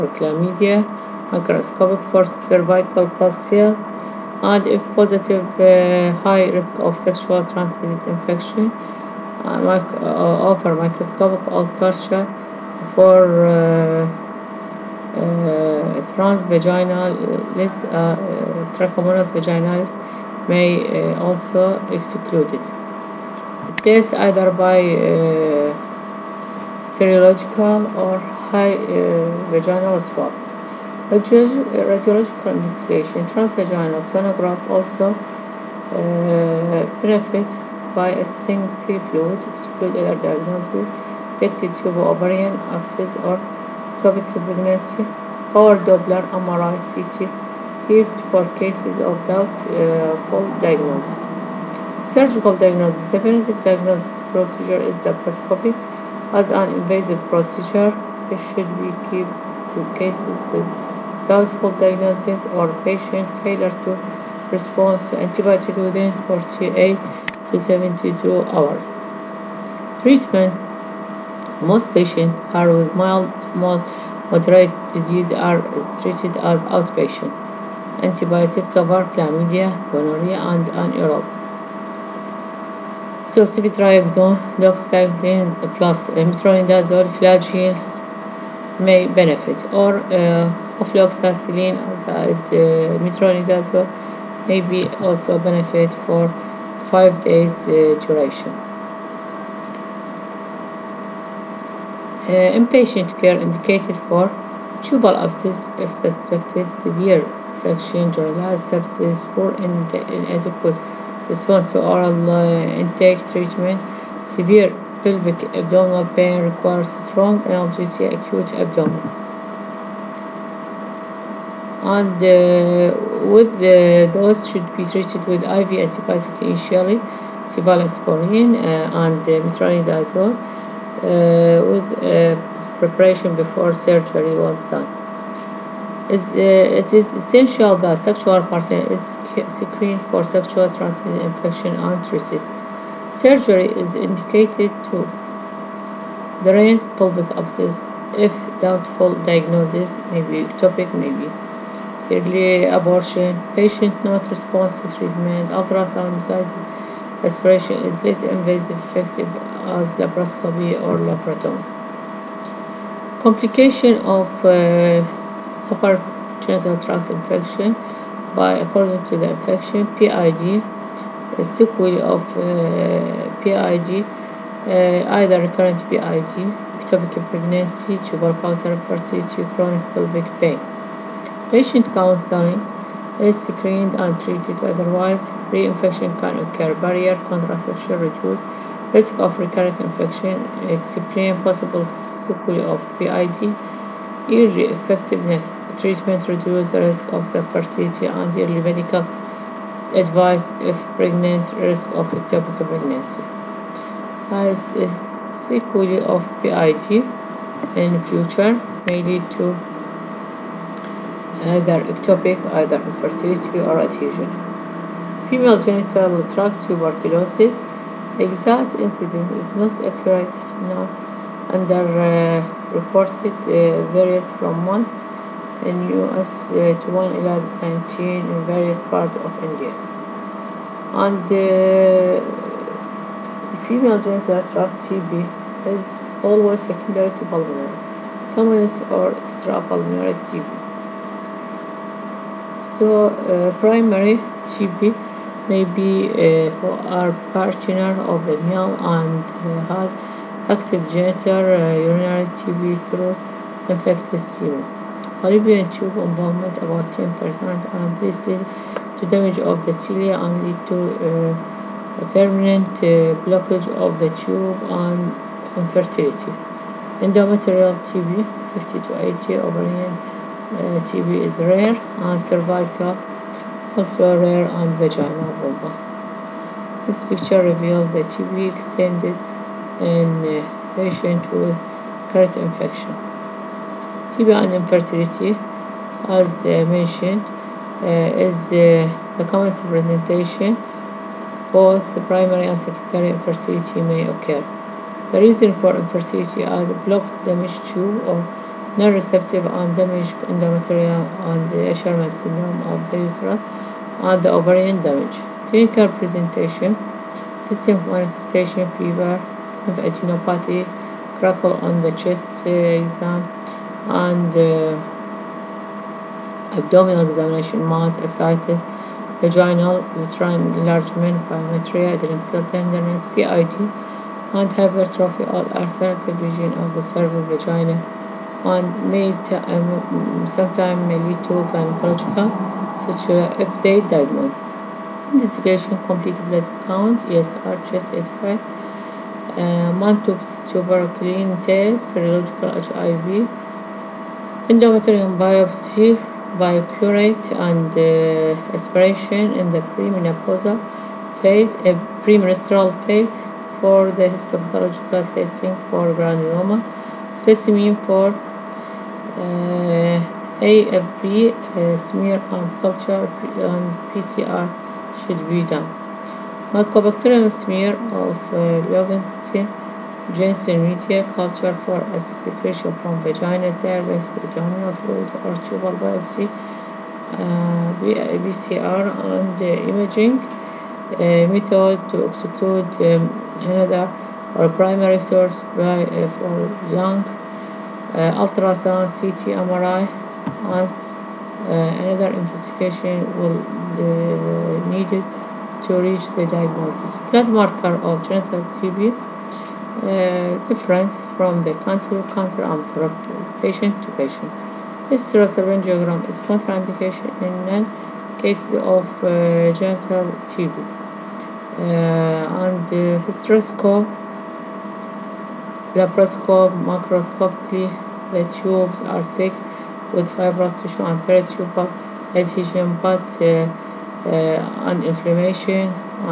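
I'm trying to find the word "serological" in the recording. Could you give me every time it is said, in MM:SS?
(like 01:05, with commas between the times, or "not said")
00:26, 05:41.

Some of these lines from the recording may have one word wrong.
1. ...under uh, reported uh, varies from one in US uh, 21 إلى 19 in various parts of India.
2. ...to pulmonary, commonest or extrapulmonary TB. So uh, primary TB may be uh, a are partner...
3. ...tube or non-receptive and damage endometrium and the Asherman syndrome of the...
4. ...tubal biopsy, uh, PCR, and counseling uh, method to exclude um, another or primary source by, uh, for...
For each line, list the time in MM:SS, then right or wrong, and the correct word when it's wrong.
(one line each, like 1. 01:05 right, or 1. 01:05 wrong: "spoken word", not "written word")
1. 03:41 right
2. 03:57 right
3. 04:57 right
4. 06:15 wrong: "imaging", not "counseling".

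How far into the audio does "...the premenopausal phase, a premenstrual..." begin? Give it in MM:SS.
05:49.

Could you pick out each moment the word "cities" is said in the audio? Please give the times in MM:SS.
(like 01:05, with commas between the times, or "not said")
not said.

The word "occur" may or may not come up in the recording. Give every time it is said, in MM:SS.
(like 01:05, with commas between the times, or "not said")
03:06, 04:54.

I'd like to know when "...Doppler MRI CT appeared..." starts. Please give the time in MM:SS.
00:45.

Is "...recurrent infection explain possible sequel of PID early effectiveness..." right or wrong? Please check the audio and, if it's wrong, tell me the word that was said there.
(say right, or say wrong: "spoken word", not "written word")
right.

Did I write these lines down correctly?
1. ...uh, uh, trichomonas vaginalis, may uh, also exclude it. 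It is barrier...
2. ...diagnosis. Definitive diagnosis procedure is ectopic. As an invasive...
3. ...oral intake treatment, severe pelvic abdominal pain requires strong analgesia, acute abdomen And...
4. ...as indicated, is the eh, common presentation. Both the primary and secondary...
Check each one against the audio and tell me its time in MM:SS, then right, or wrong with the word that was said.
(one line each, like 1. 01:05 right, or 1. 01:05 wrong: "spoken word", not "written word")
1. 00:17 wrong: "either", not "barrier"
2. 00:52 wrong: "laparoscopic", not "ectopic"
3. 01:51 right
4. 04:46 wrong: "mentioned", not "indicated".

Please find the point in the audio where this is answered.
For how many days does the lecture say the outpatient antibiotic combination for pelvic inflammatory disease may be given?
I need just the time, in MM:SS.
01:36.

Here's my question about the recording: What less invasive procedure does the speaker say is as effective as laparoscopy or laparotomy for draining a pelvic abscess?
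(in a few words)
Ultrasound guided aspiration.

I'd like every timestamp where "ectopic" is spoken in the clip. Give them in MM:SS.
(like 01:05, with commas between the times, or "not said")
02:30, 02:56, 03:22, 03:31.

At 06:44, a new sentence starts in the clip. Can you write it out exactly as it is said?
Hysterosalpingography is contraindication in cases of uh, genital TB.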